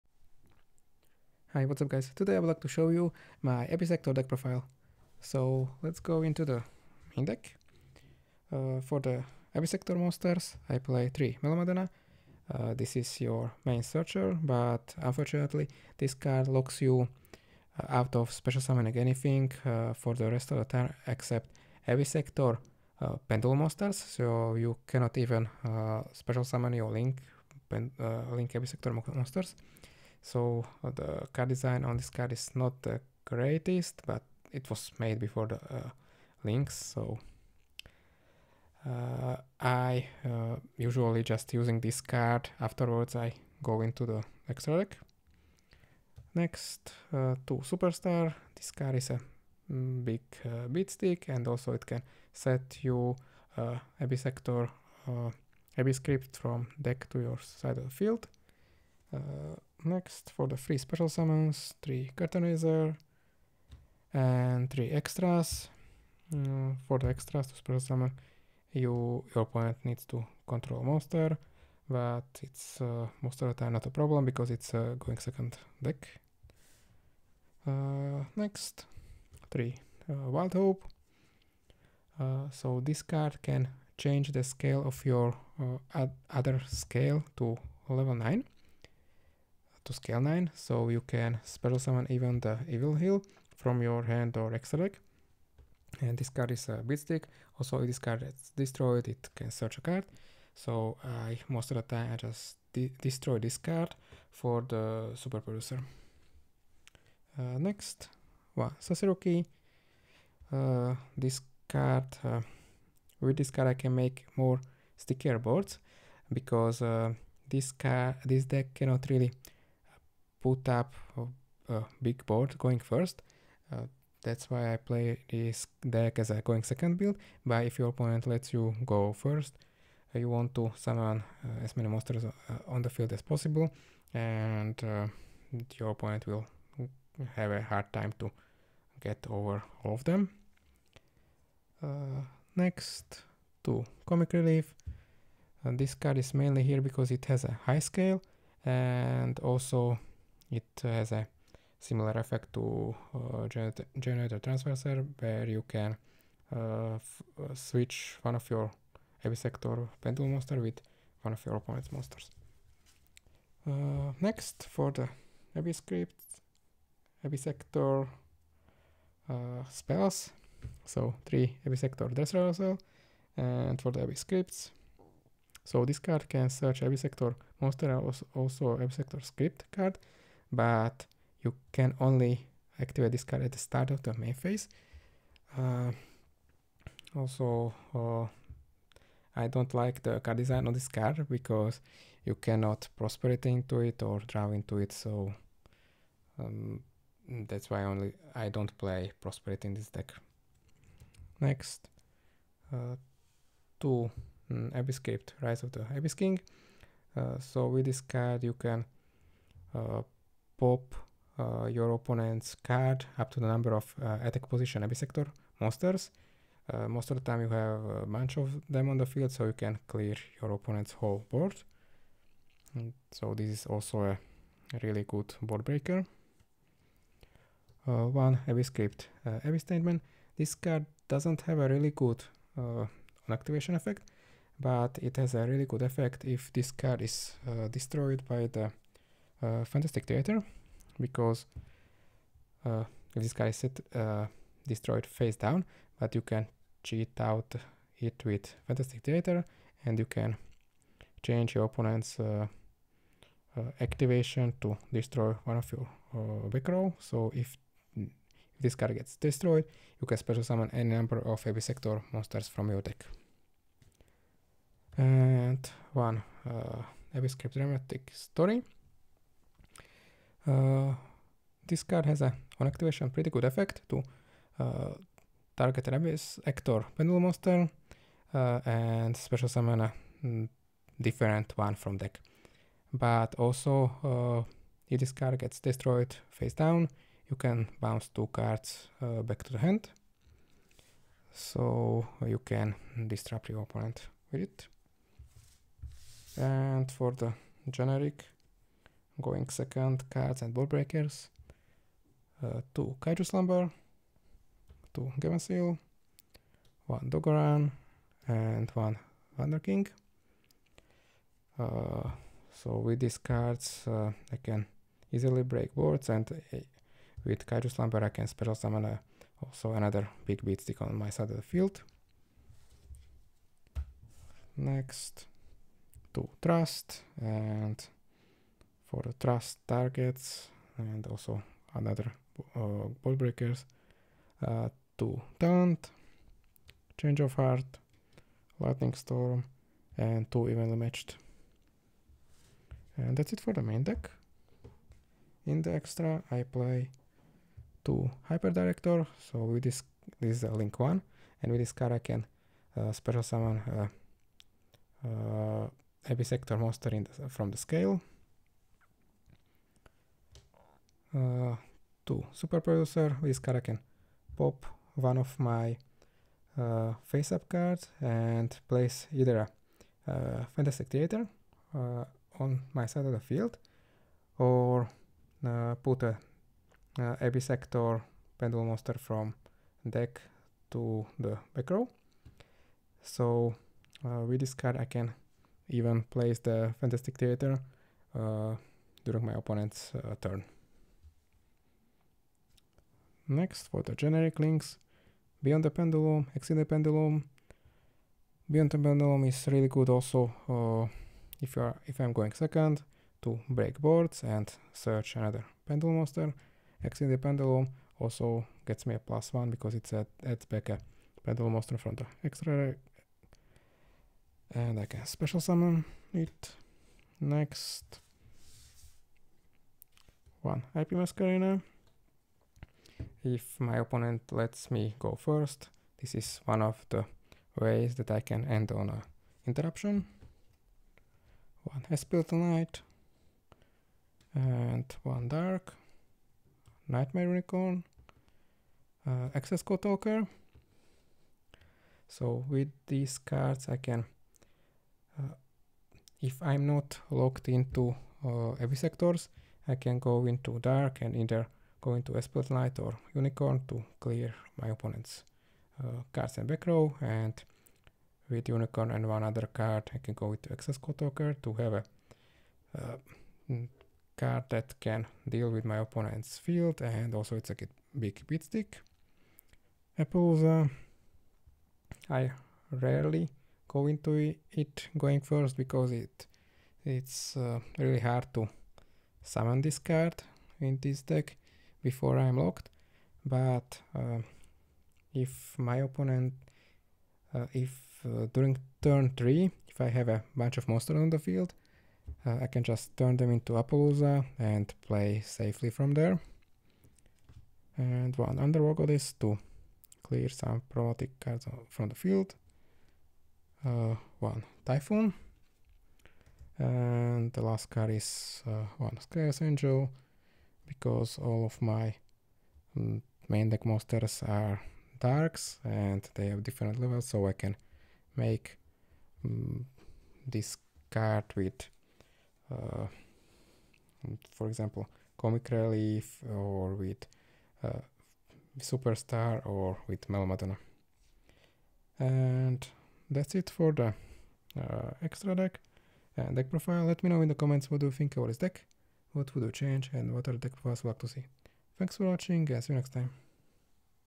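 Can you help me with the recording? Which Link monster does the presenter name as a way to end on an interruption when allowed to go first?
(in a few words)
I:P Masquerena.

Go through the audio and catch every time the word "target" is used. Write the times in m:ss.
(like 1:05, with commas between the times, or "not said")
4:35, 5:29.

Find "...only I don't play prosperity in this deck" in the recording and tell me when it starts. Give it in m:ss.
3:17.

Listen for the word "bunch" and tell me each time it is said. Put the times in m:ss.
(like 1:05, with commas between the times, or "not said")
3:38, 8:10.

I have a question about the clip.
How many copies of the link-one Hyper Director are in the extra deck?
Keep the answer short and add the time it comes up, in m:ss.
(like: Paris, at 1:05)
2, at 5:47.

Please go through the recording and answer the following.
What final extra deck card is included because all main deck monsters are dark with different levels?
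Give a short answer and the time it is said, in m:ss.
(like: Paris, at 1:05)
Sky Angel, at 8:28.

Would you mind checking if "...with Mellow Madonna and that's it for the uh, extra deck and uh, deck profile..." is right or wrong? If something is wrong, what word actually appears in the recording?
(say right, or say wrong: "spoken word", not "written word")
right.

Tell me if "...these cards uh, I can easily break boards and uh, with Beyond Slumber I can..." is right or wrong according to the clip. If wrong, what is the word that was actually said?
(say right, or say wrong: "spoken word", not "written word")
wrong: "Kaiju", not "Beyond".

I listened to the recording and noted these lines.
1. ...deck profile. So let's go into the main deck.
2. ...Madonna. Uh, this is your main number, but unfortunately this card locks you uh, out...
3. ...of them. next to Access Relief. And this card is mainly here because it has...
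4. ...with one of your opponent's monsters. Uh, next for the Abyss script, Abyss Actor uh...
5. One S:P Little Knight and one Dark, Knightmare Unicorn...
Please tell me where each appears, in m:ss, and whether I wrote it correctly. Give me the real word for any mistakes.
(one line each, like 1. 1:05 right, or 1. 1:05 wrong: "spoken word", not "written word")
1. 0:04 right
2. 0:11 wrong: "searcher", not "number"
3. 2:19 wrong: "Comic", not "Access"
4. 2:40 right
5. 7:11 right.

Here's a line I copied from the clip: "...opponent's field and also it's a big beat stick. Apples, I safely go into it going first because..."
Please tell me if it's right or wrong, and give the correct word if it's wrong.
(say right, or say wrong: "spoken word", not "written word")
wrong: "rarely", not "safely".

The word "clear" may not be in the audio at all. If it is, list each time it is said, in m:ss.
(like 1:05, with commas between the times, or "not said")
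3:39, 7:33, 8:20.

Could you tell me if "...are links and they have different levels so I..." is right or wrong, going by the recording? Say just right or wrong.
wrong.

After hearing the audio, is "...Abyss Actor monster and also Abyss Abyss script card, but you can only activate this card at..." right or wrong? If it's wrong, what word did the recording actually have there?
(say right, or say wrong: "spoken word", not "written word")
wrong: "Actor", not "Abyss".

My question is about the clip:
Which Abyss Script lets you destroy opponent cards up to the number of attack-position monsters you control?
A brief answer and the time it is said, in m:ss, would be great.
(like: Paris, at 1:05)
Rise of the Abyss King, at 3:25.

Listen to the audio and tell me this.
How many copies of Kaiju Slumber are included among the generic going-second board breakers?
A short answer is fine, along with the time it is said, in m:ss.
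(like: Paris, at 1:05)
2, at 5:02.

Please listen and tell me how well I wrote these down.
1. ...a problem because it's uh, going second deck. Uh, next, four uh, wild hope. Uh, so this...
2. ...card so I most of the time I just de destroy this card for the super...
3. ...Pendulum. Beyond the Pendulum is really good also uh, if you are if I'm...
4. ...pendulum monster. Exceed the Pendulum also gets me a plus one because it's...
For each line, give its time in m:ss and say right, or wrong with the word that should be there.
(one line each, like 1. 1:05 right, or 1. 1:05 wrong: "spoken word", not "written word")
1. 1:13 wrong: "three", not "four"
2. 1:39 right
3. 6:36 right
4. 6:45 right.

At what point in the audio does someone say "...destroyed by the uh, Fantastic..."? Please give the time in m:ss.
3:57.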